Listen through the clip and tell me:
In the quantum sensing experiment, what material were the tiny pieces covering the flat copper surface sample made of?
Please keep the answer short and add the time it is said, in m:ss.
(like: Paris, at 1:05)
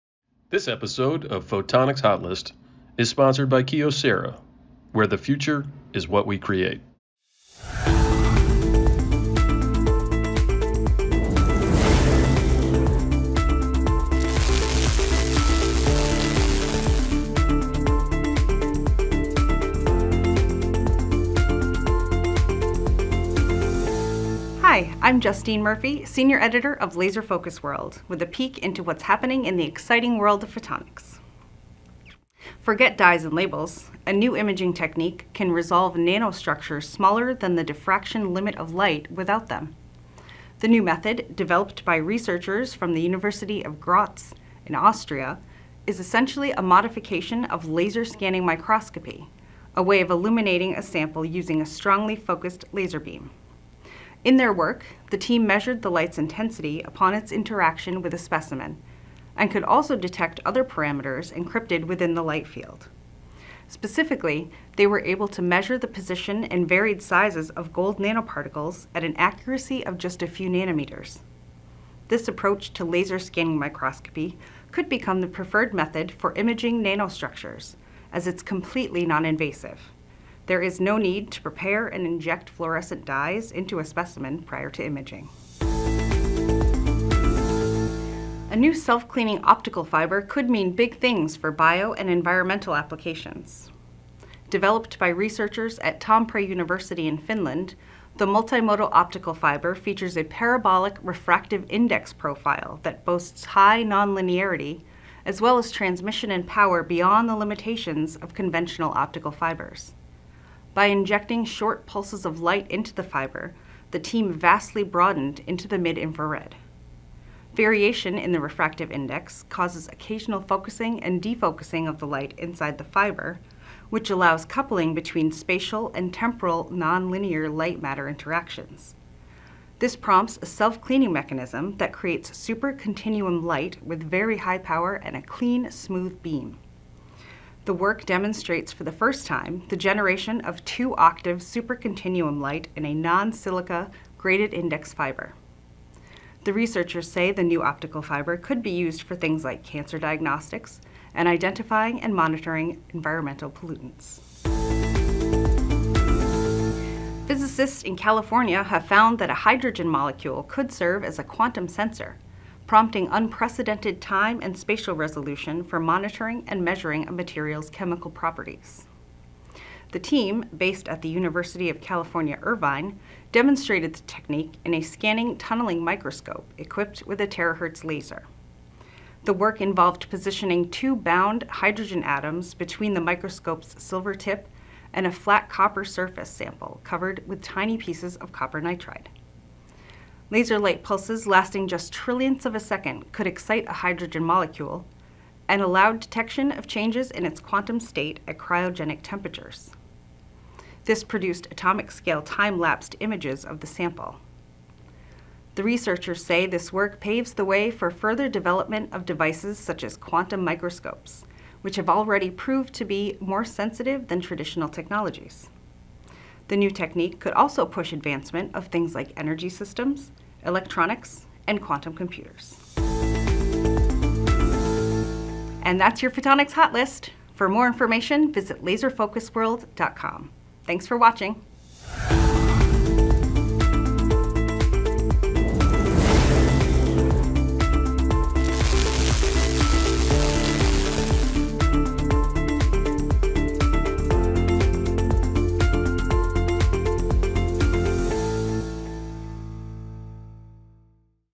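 Copper nitride, at 3:08.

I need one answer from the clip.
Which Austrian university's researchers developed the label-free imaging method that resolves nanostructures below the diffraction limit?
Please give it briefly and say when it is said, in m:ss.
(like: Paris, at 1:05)
University of Graz, at 0:43.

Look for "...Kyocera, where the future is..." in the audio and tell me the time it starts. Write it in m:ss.
0:03.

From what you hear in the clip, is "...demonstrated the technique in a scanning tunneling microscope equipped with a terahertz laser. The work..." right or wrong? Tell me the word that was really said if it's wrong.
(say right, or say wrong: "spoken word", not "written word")
right.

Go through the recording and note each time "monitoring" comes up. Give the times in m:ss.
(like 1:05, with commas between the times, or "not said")
2:32, 2:45.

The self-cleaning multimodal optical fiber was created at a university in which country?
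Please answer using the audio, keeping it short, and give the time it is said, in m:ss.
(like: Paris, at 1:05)
Finland, at 1:37.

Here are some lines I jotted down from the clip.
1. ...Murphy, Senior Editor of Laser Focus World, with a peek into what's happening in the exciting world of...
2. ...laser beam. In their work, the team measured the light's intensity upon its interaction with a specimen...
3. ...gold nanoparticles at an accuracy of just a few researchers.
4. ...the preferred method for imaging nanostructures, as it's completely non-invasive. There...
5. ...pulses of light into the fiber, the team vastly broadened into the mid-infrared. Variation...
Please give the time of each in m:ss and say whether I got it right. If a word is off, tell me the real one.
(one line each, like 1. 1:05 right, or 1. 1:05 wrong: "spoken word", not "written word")
1. 0:25 right
2. 0:52 right
3. 1:07 wrong: "nanometers", not "researchers"
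4. 1:15 right
5. 1:51 right.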